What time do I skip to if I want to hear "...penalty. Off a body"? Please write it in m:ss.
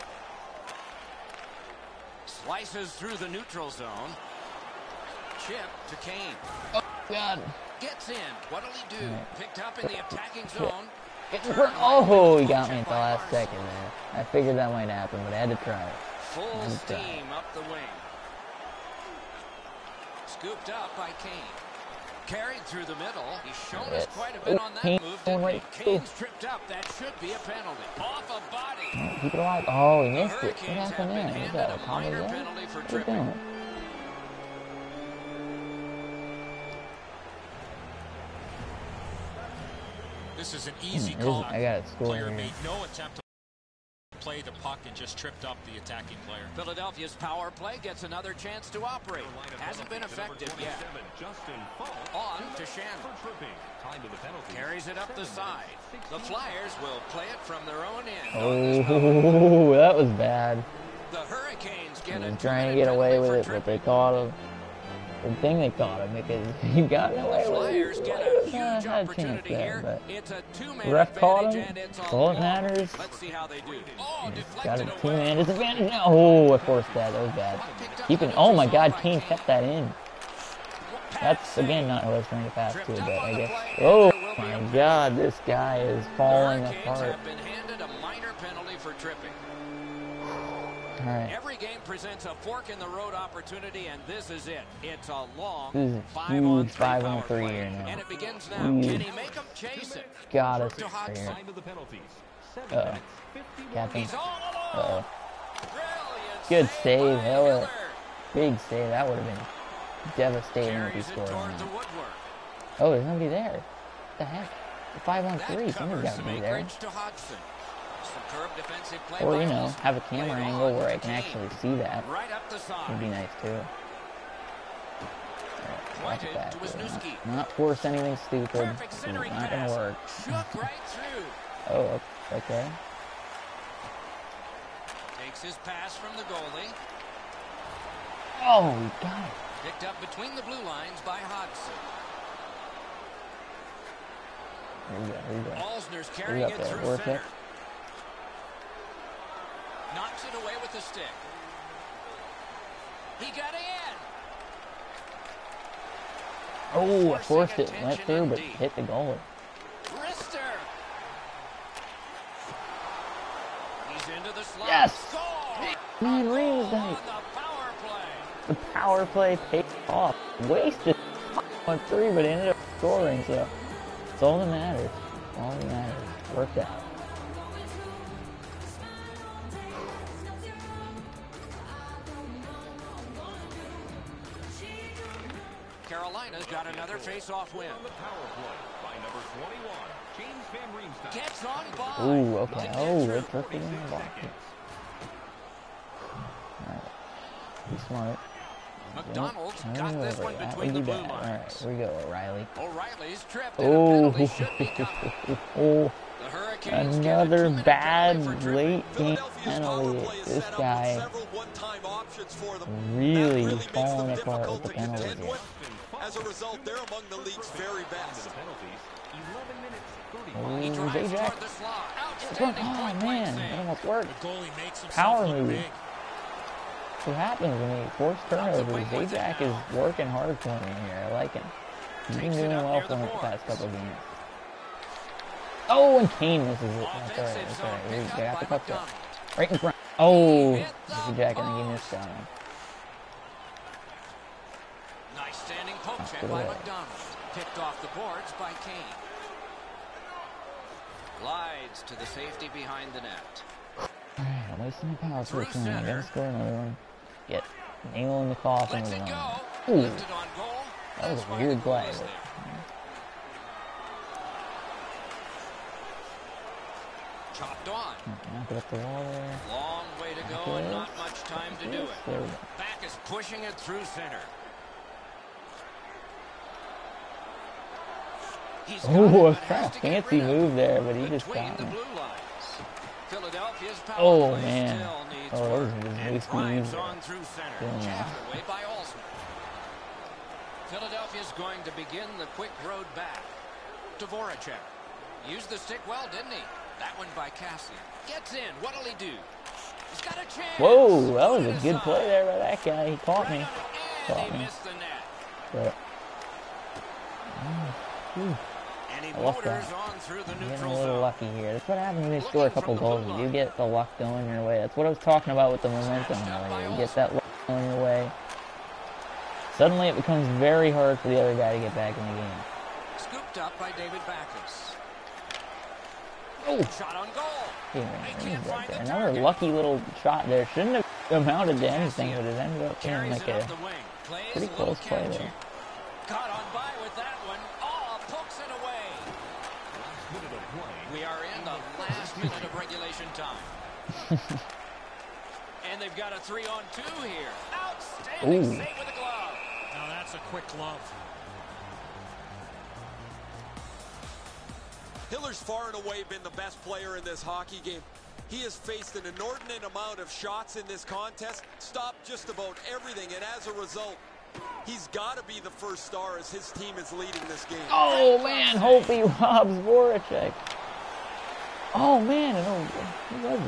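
0:27.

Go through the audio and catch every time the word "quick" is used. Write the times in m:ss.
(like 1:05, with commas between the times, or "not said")
4:52, 5:50.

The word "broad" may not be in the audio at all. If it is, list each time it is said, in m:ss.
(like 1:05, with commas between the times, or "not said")
not said.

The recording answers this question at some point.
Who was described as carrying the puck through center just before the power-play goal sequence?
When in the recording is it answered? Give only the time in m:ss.
2:25.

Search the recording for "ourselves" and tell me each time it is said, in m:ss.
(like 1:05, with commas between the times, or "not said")
not said.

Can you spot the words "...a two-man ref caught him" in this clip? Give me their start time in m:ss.
1:10.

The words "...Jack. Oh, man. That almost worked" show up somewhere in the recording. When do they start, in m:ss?
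3:41.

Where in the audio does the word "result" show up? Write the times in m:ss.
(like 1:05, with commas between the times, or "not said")
3:36, 6:03.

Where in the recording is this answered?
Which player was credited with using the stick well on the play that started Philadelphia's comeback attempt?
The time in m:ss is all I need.
4:57.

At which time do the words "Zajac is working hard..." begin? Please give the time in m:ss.
3:49.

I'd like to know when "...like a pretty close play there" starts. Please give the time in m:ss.
5:33.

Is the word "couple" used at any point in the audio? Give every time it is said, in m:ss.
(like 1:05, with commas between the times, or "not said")
3:53, 5:12.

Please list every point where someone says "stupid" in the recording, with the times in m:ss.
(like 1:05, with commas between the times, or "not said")
2:08.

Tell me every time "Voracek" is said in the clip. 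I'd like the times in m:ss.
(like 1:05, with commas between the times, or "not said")
4:54, 6:09.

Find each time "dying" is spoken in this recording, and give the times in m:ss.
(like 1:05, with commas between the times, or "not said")
not said.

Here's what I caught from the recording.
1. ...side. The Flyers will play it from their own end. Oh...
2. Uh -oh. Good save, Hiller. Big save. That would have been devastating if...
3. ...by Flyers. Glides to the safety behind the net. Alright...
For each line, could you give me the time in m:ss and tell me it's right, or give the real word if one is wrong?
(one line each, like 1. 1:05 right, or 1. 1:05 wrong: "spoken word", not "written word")
1. 0:55 right
2. 1:43 right
3. 4:08 wrong: "Kane", not "Flyers".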